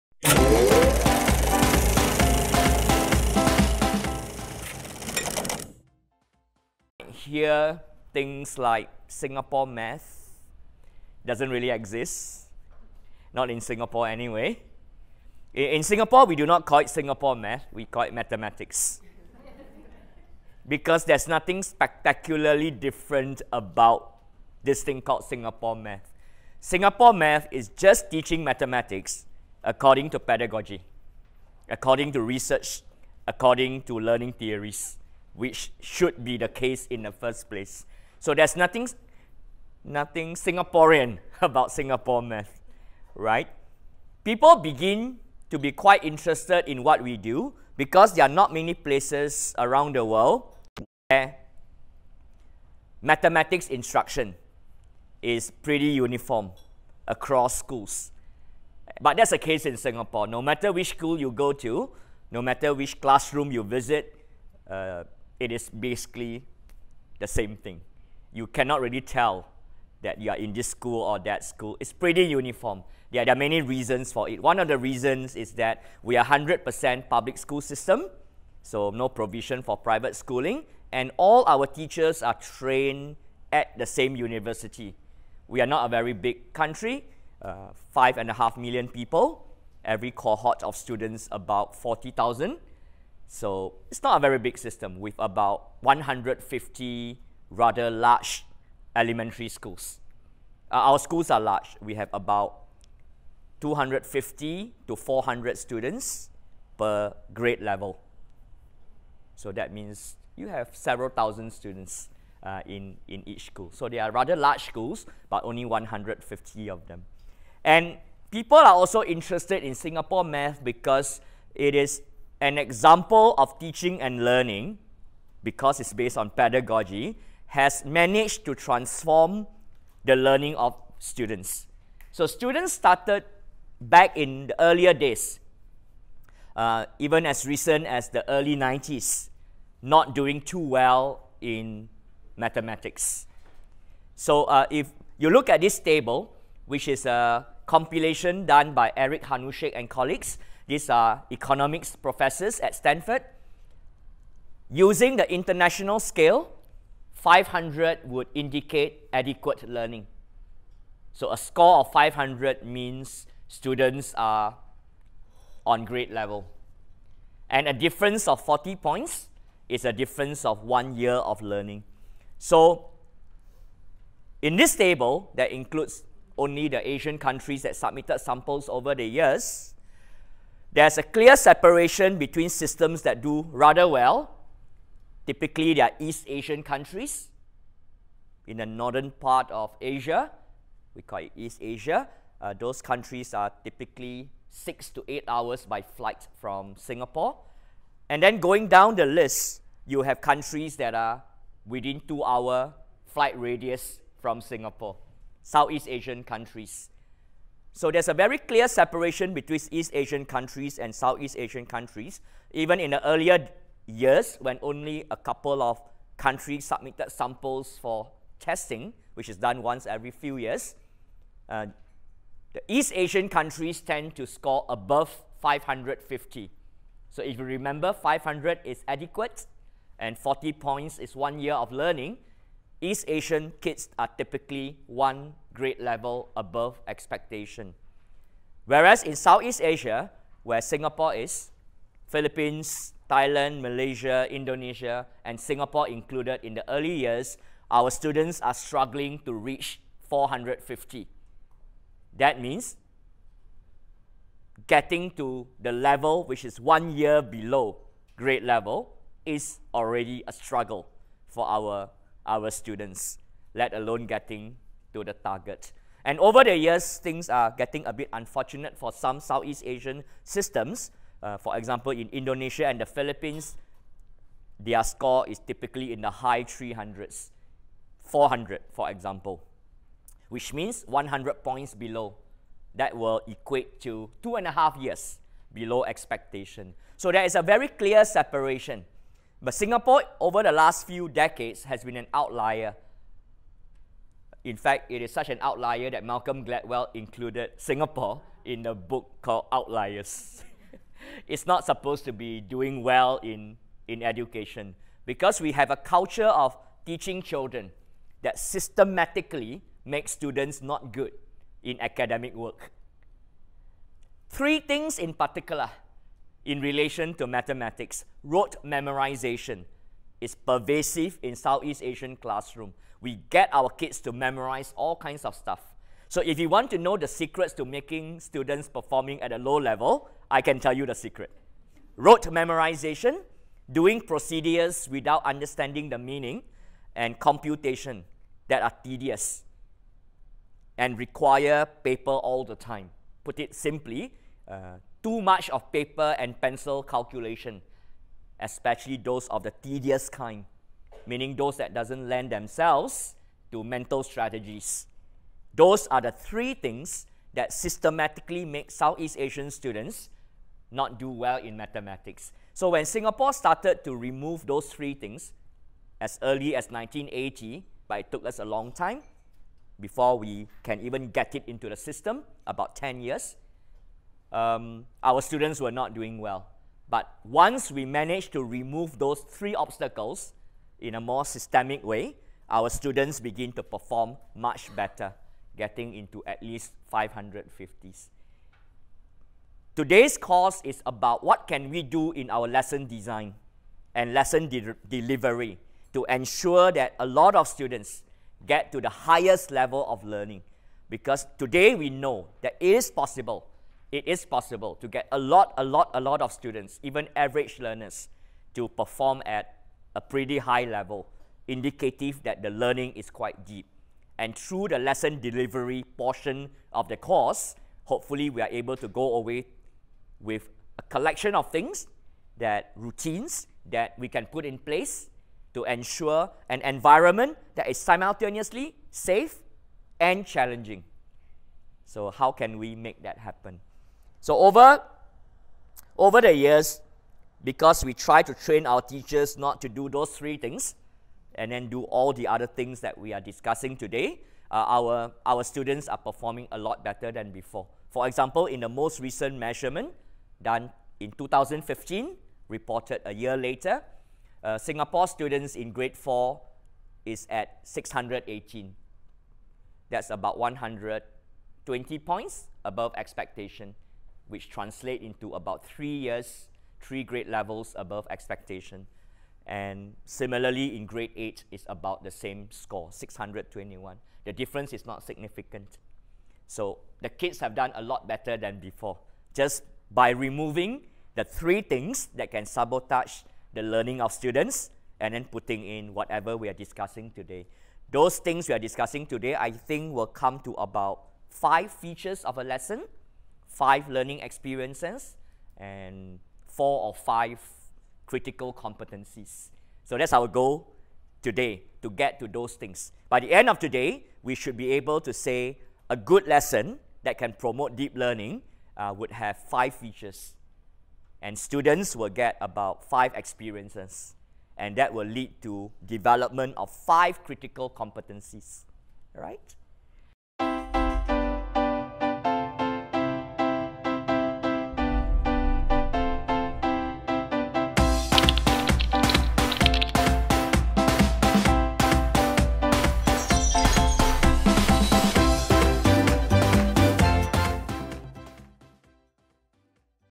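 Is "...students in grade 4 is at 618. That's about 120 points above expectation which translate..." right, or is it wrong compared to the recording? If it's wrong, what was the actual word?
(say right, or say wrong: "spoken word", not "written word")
right.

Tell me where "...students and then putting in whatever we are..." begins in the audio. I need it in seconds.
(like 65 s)
484 s.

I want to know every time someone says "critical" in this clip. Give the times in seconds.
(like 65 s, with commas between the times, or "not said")
498 s, 517 s.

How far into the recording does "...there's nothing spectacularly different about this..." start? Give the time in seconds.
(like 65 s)
21 s.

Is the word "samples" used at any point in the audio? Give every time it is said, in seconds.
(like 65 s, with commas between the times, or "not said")
178 s, 217 s.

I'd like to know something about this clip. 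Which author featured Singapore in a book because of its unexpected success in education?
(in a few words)
Malcolm Gladwell.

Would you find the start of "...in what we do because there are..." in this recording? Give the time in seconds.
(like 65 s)
46 s.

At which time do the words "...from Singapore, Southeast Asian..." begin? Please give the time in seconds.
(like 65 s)
204 s.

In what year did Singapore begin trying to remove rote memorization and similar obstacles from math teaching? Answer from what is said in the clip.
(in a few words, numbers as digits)
1980.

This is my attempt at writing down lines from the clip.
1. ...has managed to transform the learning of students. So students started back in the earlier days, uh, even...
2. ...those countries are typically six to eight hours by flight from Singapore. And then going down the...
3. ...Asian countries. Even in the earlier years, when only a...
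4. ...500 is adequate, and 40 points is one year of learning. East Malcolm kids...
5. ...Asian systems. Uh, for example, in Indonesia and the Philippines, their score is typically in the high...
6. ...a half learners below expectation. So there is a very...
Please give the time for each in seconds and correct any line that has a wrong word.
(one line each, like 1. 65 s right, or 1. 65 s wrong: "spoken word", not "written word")
1. 127 s right
2. 192 s right
3. 211 s right
4. 227 s wrong: "Asian", not "Malcolm"
5. 269 s right
6. 284 s wrong: "years", not "learners".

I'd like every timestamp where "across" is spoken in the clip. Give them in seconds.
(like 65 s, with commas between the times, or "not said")
57 s.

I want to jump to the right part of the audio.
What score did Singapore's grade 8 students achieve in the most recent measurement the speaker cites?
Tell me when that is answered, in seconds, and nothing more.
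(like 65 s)
472 s.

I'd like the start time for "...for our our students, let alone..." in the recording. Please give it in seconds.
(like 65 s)
261 s.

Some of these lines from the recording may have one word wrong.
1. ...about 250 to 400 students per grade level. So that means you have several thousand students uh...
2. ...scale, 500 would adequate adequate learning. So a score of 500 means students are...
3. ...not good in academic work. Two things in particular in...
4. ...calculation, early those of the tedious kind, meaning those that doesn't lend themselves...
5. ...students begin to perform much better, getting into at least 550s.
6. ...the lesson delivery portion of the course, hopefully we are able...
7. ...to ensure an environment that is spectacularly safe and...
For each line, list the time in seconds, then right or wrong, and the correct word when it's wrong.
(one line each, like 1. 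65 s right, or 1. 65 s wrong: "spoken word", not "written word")
1. 102 s right
2. 155 s wrong: "indicate", not "adequate"
3. 310 s wrong: "Three", not "Two"
4. 346 s wrong: "especially", not "early"
5. 382 s right
6. 414 s right
7. 425 s wrong: "simultaneously", not "spectacularly".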